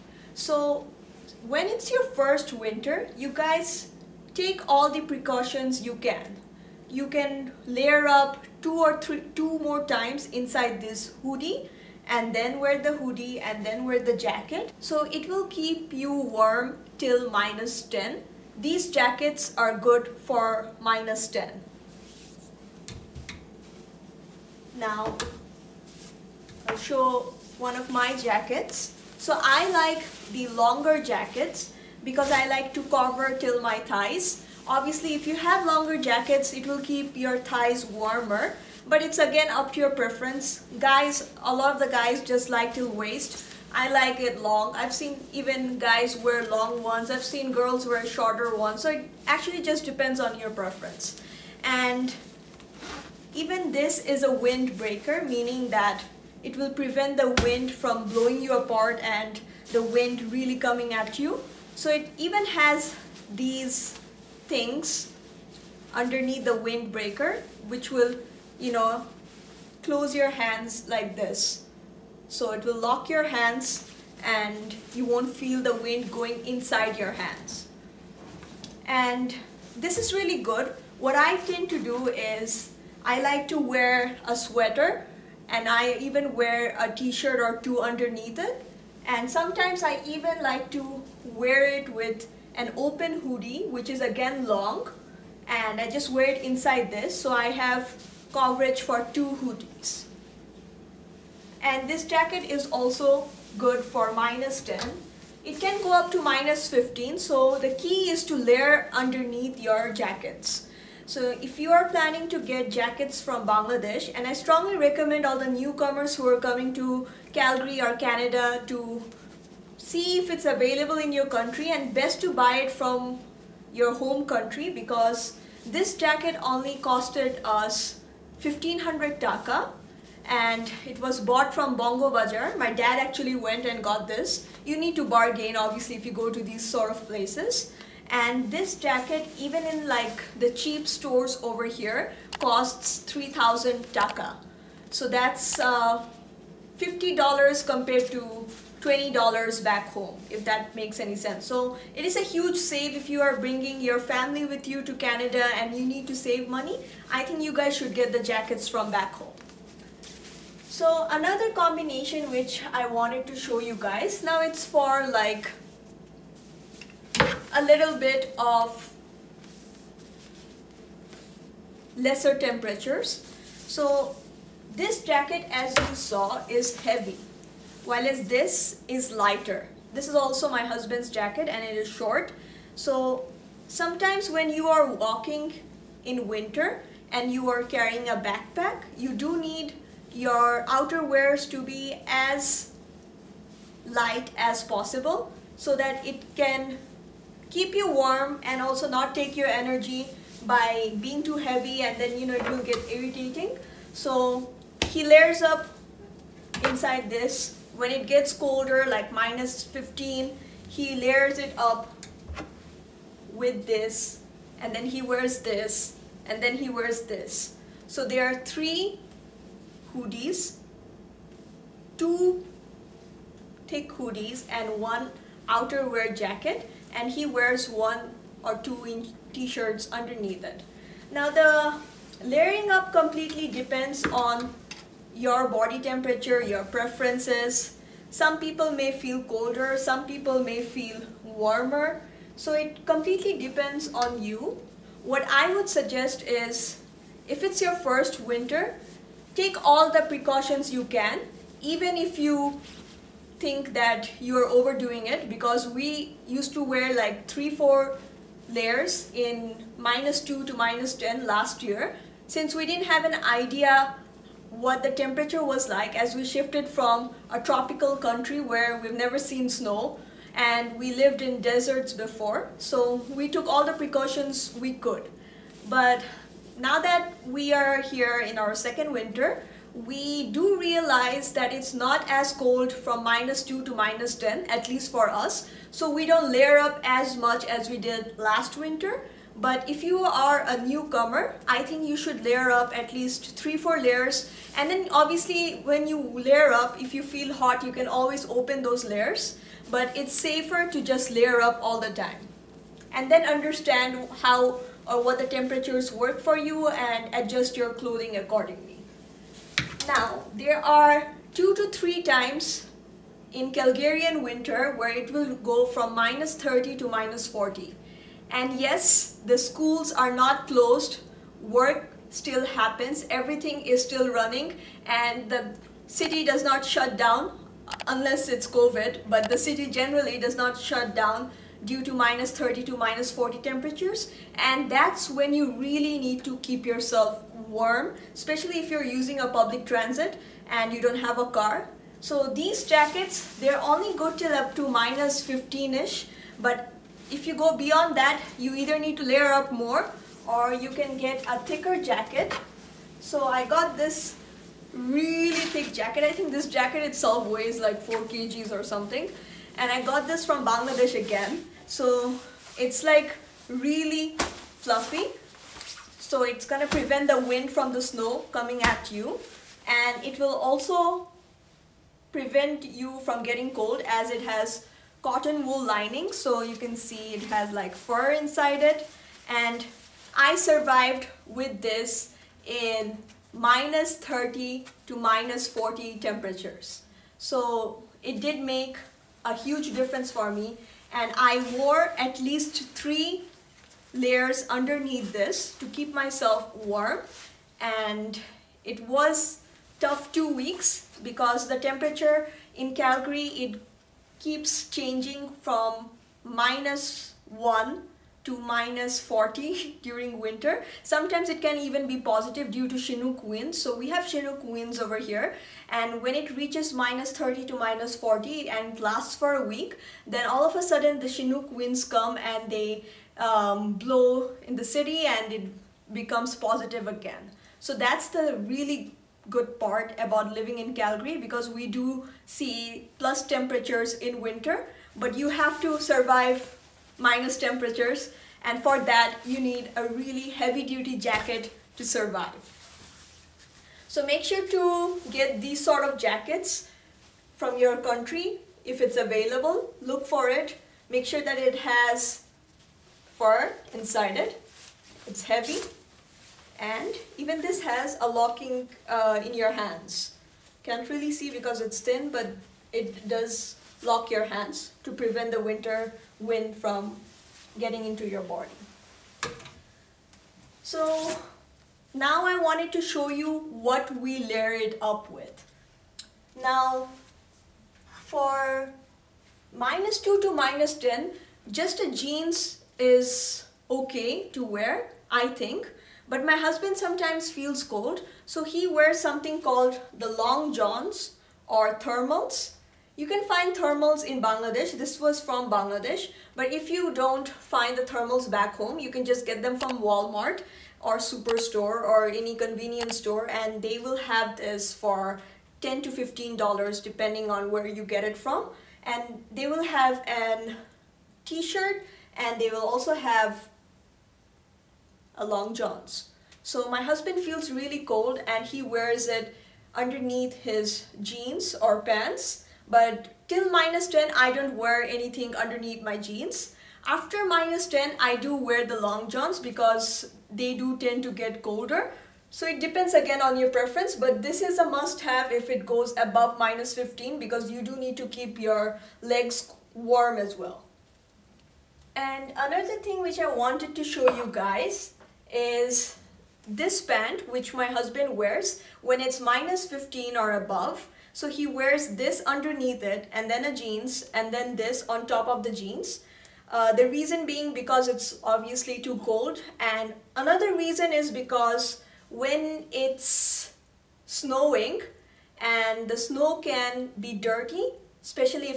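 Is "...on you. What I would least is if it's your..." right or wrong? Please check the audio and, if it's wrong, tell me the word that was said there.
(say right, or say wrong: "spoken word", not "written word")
wrong: "suggest", not "least".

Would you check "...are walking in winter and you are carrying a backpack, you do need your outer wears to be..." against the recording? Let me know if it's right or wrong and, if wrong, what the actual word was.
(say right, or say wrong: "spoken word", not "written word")
right.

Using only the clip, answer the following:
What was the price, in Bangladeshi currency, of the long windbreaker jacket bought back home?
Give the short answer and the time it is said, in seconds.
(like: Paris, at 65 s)
1500 taka, at 128 s.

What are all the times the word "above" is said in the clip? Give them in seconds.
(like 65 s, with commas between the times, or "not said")
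536 s, 550 s.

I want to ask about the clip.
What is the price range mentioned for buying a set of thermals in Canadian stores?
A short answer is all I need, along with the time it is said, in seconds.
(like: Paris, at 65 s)
10 to 15 dollars, at 505 s.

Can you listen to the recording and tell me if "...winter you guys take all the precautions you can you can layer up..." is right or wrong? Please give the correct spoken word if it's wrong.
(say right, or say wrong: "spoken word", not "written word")
right.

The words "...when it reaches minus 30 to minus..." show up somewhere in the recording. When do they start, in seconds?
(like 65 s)
416 s.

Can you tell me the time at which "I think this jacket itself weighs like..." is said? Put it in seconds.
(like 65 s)
356 s.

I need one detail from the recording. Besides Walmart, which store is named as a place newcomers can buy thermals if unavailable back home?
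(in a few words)
Superstore.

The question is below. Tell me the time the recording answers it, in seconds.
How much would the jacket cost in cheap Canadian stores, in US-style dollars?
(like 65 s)
146 s.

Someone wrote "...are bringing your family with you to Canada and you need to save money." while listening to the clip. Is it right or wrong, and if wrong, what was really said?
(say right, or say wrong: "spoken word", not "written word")
right.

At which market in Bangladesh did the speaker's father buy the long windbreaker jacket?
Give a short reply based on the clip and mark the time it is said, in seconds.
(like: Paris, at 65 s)
Bongo Bazaar, at 131 s.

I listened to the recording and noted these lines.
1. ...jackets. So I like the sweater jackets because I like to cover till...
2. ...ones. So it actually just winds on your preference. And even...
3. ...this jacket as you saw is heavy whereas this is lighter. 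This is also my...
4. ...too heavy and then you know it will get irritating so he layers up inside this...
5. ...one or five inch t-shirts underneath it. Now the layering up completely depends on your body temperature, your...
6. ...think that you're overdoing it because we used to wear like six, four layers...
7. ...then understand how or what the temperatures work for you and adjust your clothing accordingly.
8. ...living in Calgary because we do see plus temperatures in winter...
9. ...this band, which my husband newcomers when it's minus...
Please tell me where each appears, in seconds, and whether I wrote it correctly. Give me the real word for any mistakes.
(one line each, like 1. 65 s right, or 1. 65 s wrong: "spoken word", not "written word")
1. 28 s wrong: "longer", not "sweater"
2. 48 s wrong: "depends", not "winds"
3. 174 s right
4. 201 s right
5. 227 s wrong: "two", not "five"
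6. 253 s wrong: "three", not "six"
7. 303 s right
8. 430 s right
9. 546 s wrong: "wears", not "newcomers".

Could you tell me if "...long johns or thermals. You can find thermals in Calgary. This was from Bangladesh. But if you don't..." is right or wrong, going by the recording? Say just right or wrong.
wrong.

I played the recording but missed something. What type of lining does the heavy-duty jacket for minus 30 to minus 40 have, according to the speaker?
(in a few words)
cotton wool lining.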